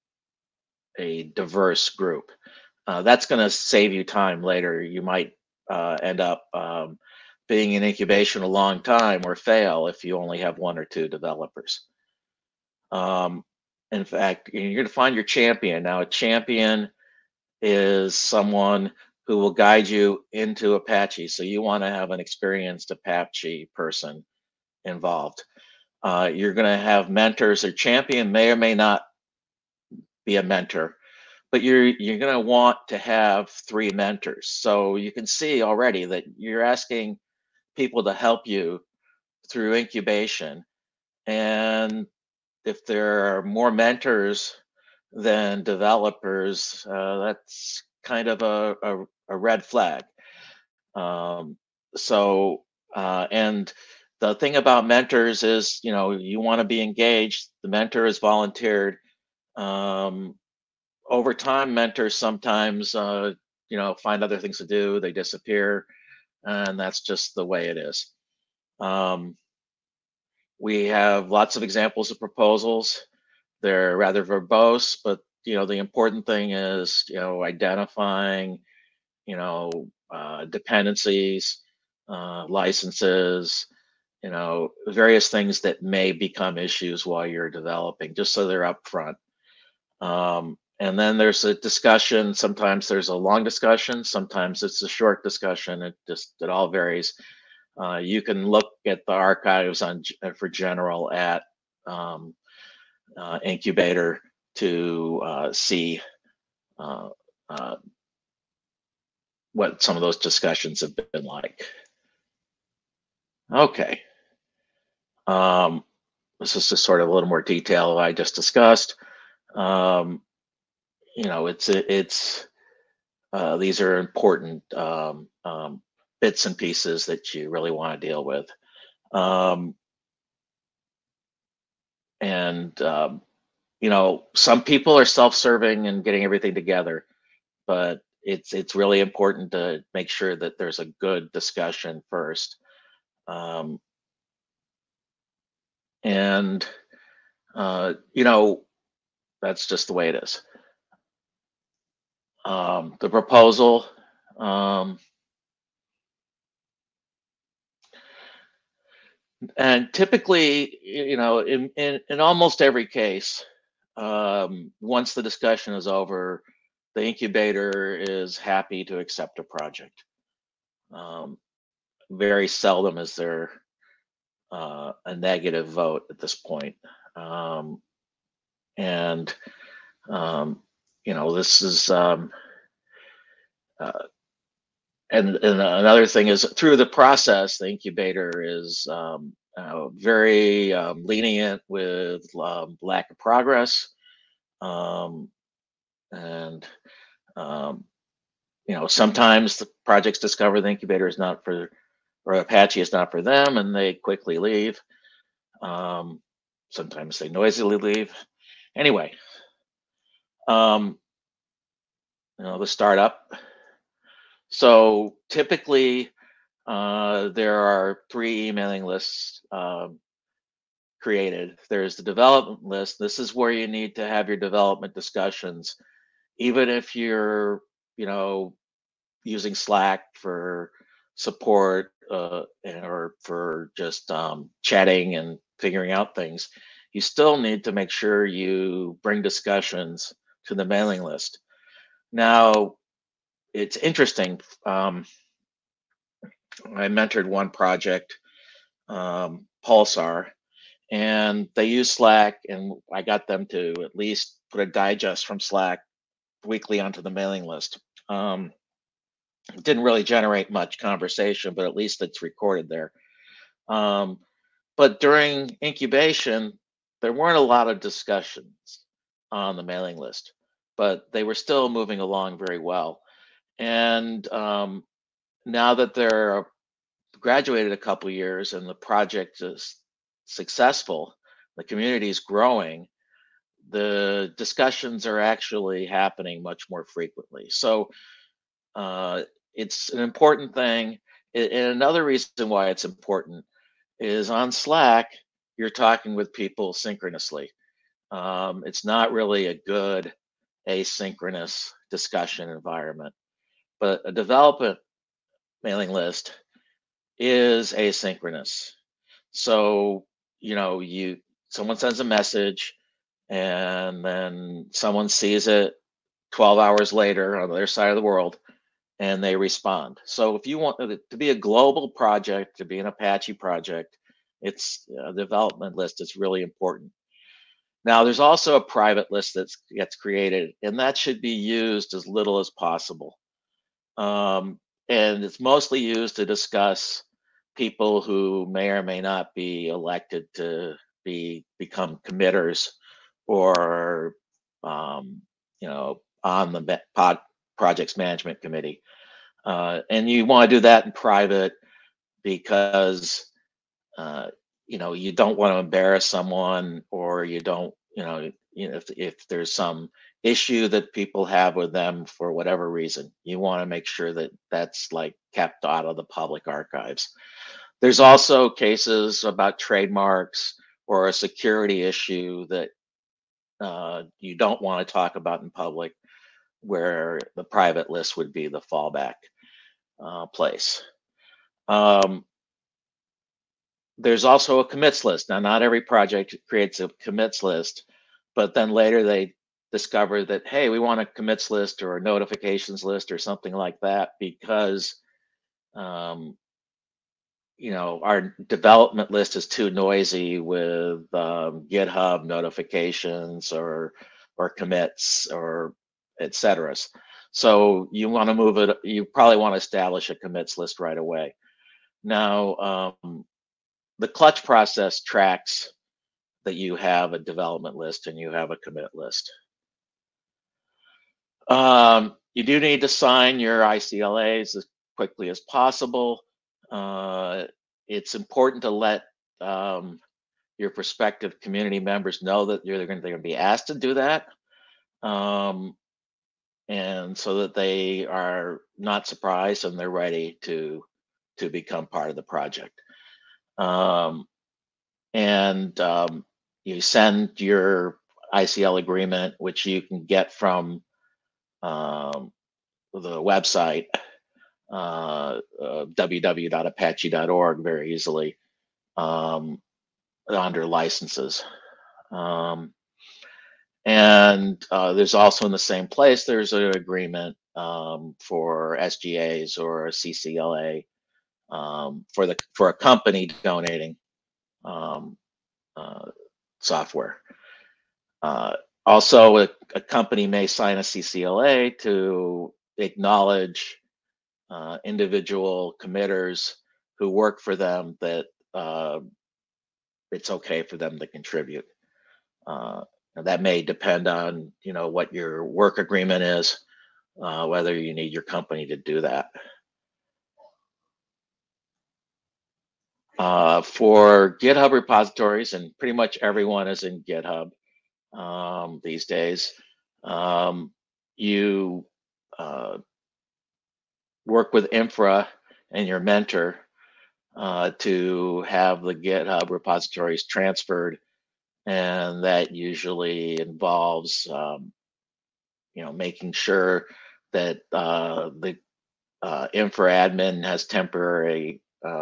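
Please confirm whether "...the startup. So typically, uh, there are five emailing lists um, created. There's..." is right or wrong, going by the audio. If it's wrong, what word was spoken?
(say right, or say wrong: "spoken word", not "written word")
wrong: "three", not "five".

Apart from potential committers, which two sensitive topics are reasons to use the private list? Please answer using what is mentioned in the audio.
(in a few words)
Trademarks or a security issue.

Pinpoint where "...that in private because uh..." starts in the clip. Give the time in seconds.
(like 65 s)
350 s.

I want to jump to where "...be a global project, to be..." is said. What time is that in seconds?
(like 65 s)
321 s.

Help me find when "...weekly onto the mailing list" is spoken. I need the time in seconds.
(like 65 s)
256 s.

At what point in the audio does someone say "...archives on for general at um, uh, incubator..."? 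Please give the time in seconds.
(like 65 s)
99 s.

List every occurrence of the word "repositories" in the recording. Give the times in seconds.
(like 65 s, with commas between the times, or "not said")
504 s, 519 s.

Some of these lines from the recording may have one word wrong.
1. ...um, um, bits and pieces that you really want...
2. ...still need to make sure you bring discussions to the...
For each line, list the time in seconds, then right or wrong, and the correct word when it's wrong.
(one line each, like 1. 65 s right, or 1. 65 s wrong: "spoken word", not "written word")
1. 124 s right
2. 236 s right.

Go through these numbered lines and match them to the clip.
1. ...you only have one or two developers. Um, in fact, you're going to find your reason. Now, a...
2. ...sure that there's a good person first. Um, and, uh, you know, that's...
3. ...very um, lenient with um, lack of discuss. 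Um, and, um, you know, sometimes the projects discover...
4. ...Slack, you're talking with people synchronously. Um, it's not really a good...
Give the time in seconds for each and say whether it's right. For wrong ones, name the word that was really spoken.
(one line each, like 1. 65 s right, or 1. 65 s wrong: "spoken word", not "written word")
1. 10 s wrong: "champion", not "reason"
2. 140 s wrong: "discussion", not "person"
3. 189 s wrong: "progress", not "discuss"
4. 294 s right.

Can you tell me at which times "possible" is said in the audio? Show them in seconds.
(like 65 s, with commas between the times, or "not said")
332 s, 425 s.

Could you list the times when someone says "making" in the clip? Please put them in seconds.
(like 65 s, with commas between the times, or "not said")
525 s.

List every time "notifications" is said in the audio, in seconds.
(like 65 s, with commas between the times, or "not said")
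392 s, 402 s.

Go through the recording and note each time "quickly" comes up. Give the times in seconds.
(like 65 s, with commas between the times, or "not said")
203 s, 424 s.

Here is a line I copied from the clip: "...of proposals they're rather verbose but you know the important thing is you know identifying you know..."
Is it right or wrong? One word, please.
right.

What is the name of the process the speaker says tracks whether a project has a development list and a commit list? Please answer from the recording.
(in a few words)
Clutch.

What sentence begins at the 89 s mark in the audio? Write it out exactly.
Um, and then there's a discussion.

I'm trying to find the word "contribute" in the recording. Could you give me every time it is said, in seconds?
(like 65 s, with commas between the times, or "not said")
491 s.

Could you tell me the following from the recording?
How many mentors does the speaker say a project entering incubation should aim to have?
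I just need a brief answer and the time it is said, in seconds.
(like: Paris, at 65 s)
3, at 33 s.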